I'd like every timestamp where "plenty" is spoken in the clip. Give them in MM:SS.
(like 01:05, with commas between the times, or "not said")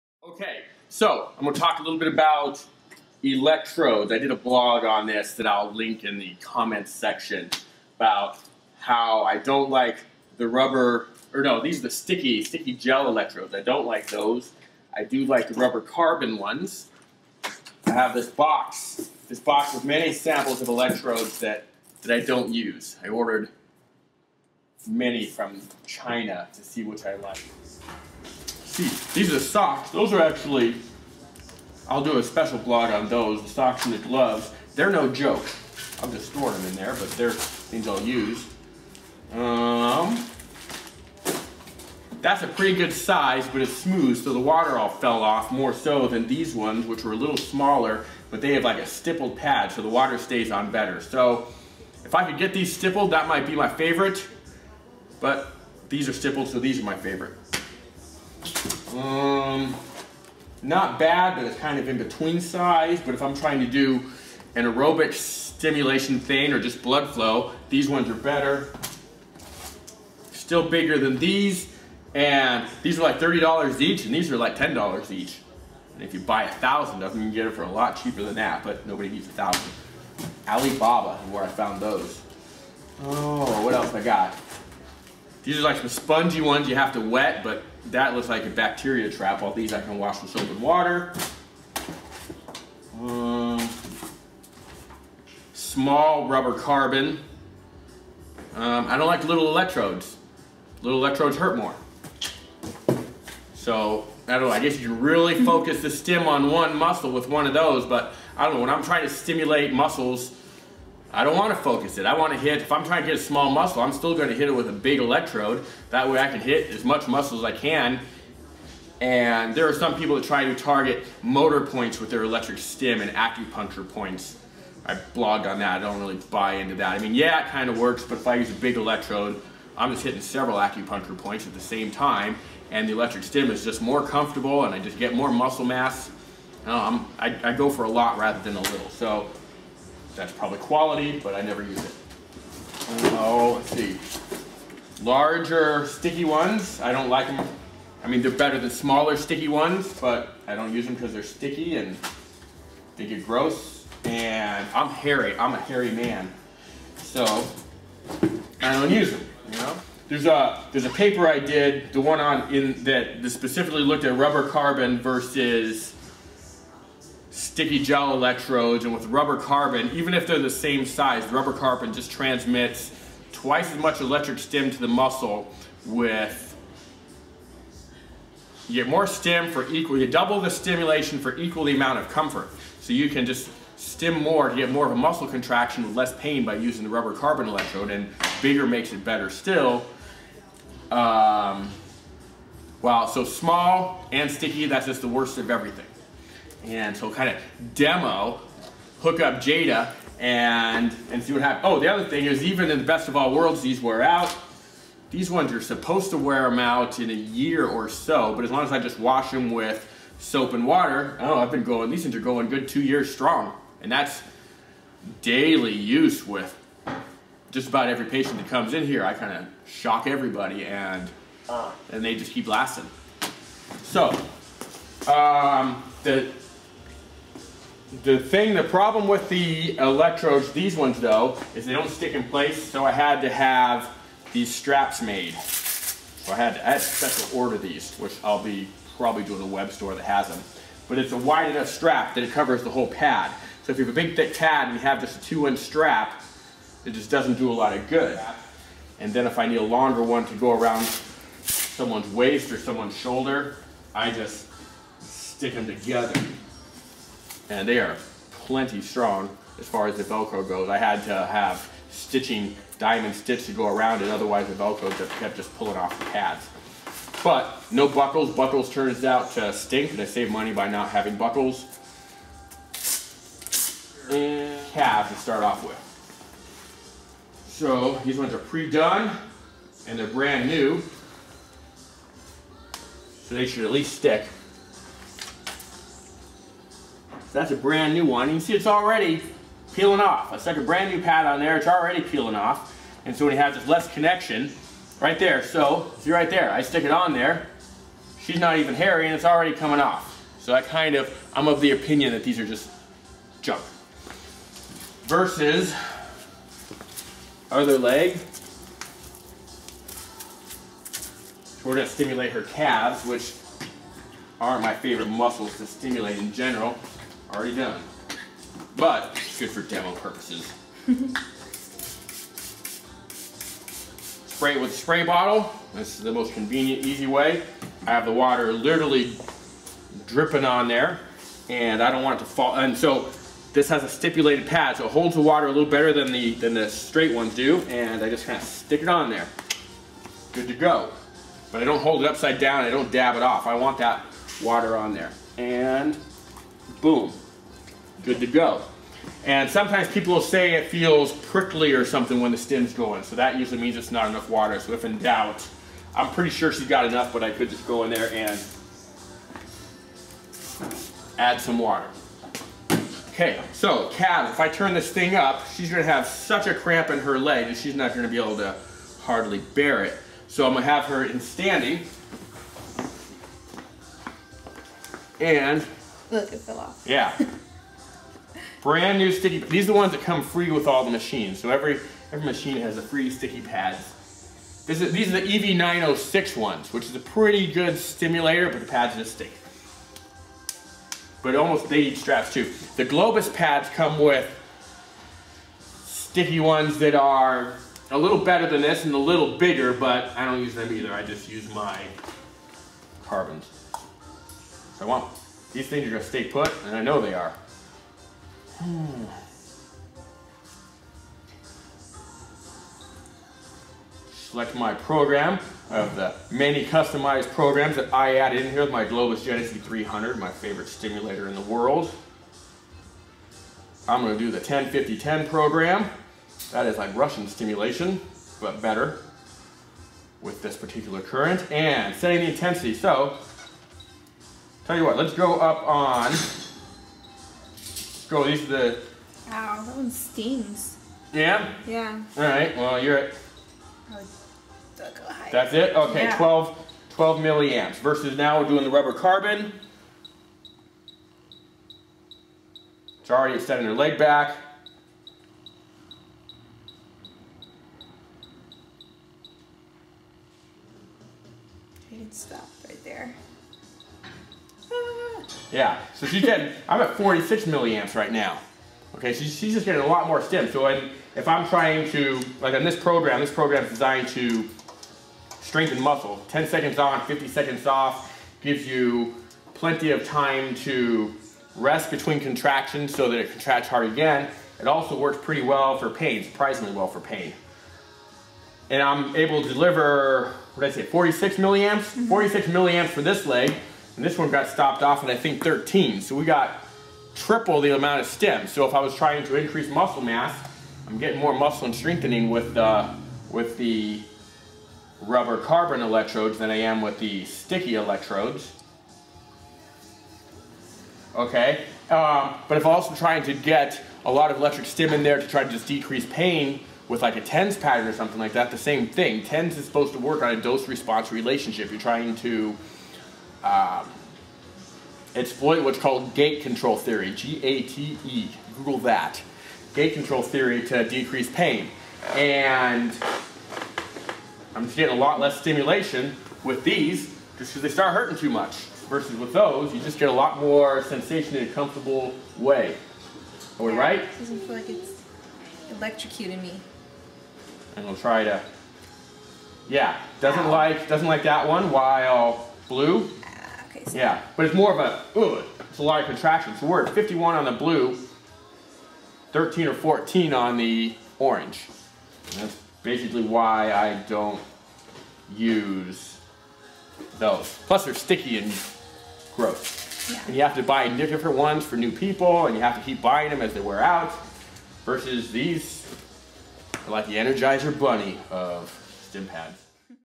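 04:18, 07:59.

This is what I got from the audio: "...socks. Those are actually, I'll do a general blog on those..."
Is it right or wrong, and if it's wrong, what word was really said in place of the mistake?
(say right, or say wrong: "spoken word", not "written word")
wrong: "special", not "general".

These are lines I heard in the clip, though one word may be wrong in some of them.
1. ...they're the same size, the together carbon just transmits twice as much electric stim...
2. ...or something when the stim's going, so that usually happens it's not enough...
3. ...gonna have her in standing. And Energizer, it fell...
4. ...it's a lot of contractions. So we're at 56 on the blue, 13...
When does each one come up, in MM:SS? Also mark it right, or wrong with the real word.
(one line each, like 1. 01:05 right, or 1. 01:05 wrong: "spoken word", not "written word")
1. 02:50 wrong: "rubber", not "together"
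2. 05:51 wrong: "means", not "happens"
3. 06:10 wrong: "Look", not "Energizer"
4. 09:15 wrong: "51", not "56".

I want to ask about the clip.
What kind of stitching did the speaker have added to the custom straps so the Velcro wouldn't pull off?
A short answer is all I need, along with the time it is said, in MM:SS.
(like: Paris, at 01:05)
Diamond stitch, at 04:22.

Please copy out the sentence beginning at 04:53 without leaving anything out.
And so when he have this less connection, right there.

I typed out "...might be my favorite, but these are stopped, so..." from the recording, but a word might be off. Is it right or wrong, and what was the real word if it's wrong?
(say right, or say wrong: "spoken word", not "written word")
wrong: "stippled", not "stopped".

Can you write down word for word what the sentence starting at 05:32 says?
And so this has a stipulated pad, so it holds the water a little better than the, than the straight ones do.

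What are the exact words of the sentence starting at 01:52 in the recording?
I want to hit, if I'm trying to hit a small muscle, I'm still going to hit it with a big electrode.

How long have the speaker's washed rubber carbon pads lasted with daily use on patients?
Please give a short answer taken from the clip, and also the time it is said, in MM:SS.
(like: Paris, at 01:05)
2 years, at 03:32.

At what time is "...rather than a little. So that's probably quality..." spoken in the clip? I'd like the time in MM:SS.
02:18.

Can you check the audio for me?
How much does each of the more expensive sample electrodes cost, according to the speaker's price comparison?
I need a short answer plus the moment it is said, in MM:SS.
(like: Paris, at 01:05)
$30, at 01:13.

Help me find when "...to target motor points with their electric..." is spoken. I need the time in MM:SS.
02:00.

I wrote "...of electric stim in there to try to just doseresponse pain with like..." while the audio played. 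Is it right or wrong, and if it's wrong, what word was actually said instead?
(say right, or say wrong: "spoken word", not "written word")
wrong: "decrease", not "doseresponse".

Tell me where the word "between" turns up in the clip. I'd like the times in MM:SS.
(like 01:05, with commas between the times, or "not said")
01:01, 08:01.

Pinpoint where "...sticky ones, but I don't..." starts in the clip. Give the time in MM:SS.
02:29.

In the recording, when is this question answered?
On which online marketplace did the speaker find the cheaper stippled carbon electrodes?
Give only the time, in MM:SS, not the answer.
01:20.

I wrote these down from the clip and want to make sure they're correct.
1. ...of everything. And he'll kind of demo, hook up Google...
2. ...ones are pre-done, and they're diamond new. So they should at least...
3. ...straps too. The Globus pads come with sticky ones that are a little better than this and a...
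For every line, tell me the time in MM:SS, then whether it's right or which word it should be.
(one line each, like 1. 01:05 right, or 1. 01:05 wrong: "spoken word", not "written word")
1. 03:15 wrong: "Jada", not "Google"
2. 04:38 wrong: "brand", not "diamond"
3. 06:31 right.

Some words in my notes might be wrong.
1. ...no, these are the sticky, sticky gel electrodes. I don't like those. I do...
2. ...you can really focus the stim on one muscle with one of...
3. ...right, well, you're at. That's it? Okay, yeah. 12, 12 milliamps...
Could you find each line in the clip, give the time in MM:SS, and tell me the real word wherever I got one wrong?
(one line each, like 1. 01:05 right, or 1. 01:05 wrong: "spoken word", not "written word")
1. 00:11 right
2. 01:44 right
3. 07:22 right.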